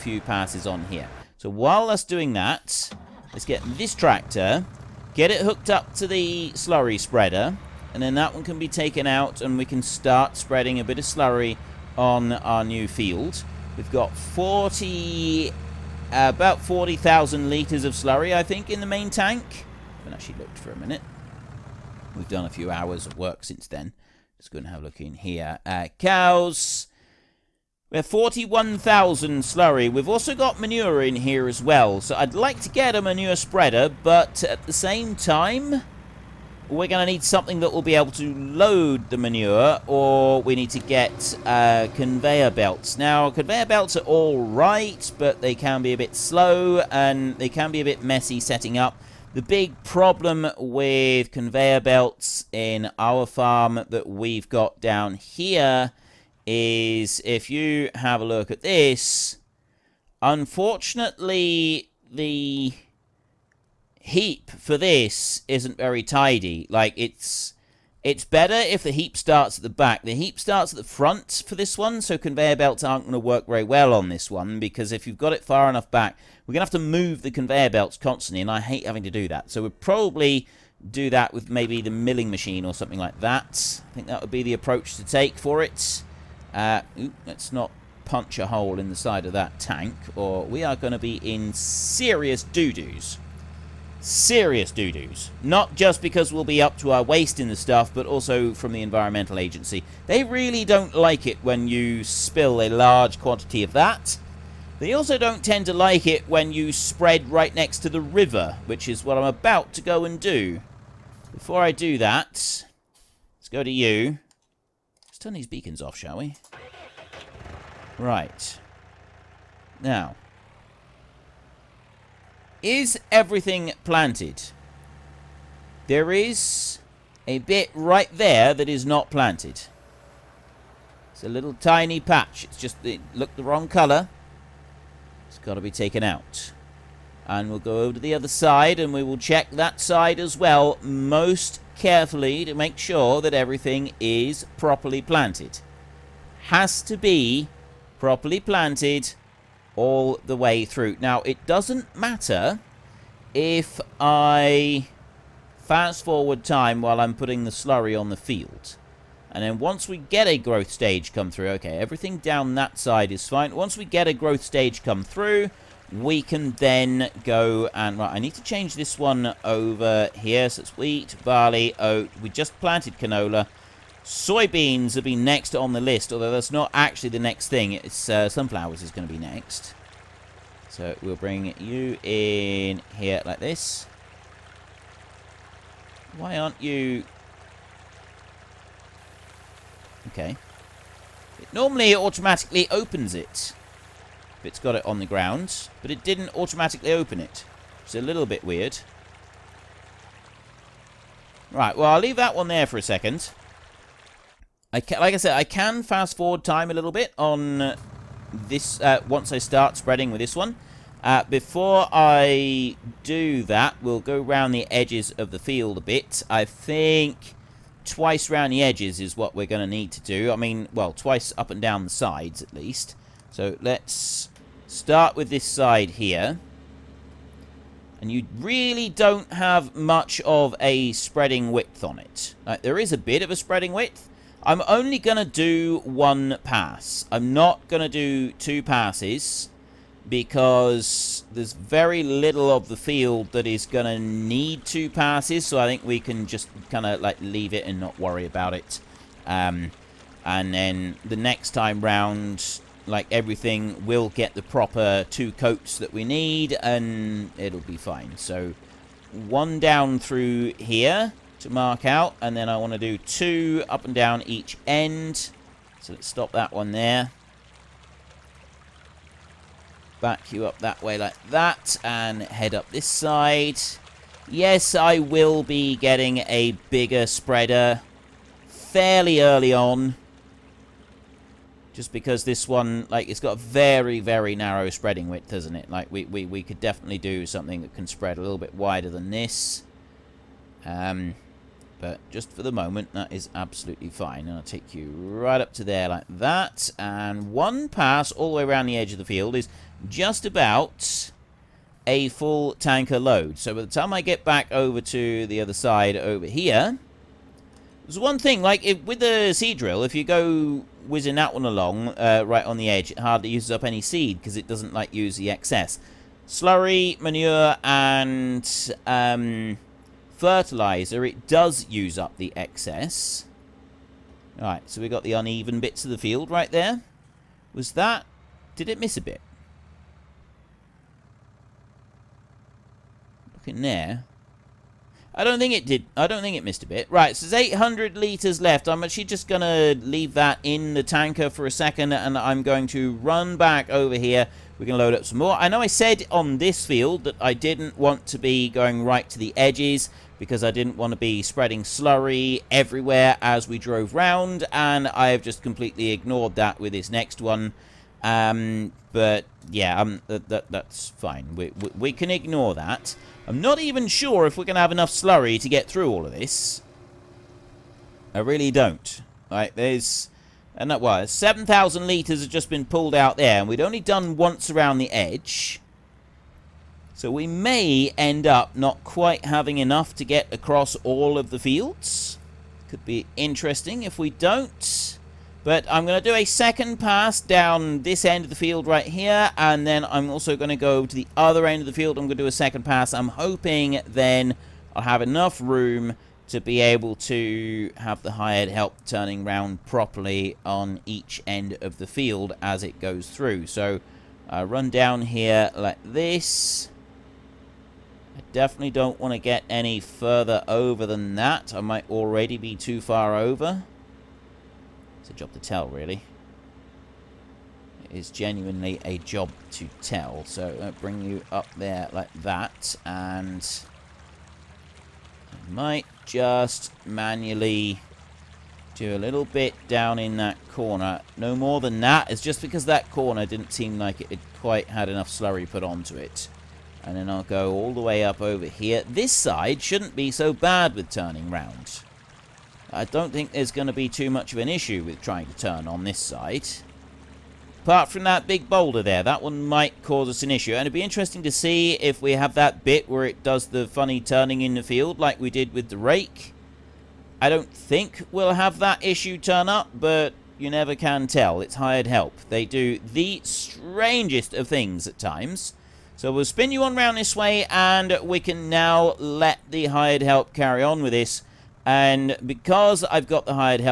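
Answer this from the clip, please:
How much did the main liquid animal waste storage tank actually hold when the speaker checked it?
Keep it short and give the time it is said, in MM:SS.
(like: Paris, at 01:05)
41,000, at 00:28.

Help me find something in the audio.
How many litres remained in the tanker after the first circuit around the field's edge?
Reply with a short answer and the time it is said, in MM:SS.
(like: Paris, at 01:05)
800, at 05:37.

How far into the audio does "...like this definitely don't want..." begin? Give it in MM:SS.
06:45.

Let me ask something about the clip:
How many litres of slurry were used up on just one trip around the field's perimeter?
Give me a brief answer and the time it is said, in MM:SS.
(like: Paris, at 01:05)
7,000, at 06:11.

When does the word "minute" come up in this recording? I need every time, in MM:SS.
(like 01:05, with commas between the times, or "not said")
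00:20.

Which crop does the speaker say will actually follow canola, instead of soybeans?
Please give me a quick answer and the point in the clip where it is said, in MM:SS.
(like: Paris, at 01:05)
sunflowers, at 02:58.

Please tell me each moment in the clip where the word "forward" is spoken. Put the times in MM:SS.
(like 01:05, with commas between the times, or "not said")
02:36, 03:26.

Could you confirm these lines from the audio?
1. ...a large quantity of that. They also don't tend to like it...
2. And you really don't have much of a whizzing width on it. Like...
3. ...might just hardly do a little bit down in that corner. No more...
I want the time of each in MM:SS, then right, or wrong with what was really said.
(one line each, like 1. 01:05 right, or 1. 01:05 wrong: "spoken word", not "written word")
1. 01:42 right
2. 03:48 wrong: "spreading", not "whizzing"
3. 07:05 wrong: "manually", not "hardly".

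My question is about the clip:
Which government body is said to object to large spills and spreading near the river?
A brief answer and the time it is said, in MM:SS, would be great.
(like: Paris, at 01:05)
Environmental Agency, at 01:38.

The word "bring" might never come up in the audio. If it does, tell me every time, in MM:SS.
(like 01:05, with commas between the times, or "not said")
03:01, 07:00.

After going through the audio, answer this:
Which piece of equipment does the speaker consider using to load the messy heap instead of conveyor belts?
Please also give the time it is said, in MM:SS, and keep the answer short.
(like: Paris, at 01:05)
milling machine, at 01:21.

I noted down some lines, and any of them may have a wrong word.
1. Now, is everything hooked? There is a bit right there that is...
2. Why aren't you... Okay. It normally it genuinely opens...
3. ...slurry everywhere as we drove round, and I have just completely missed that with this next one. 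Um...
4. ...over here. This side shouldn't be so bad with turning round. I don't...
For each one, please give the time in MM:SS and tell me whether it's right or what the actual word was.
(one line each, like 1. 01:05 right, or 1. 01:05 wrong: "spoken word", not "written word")
1. 01:59 wrong: "planted", not "hooked"
2. 03:06 wrong: "automatically", not "genuinely"
3. 05:51 wrong: "ignored", not "missed"
4. 07:18 right.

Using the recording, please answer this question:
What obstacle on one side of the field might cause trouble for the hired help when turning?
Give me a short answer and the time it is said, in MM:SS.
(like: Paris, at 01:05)
big boulder, at 07:28.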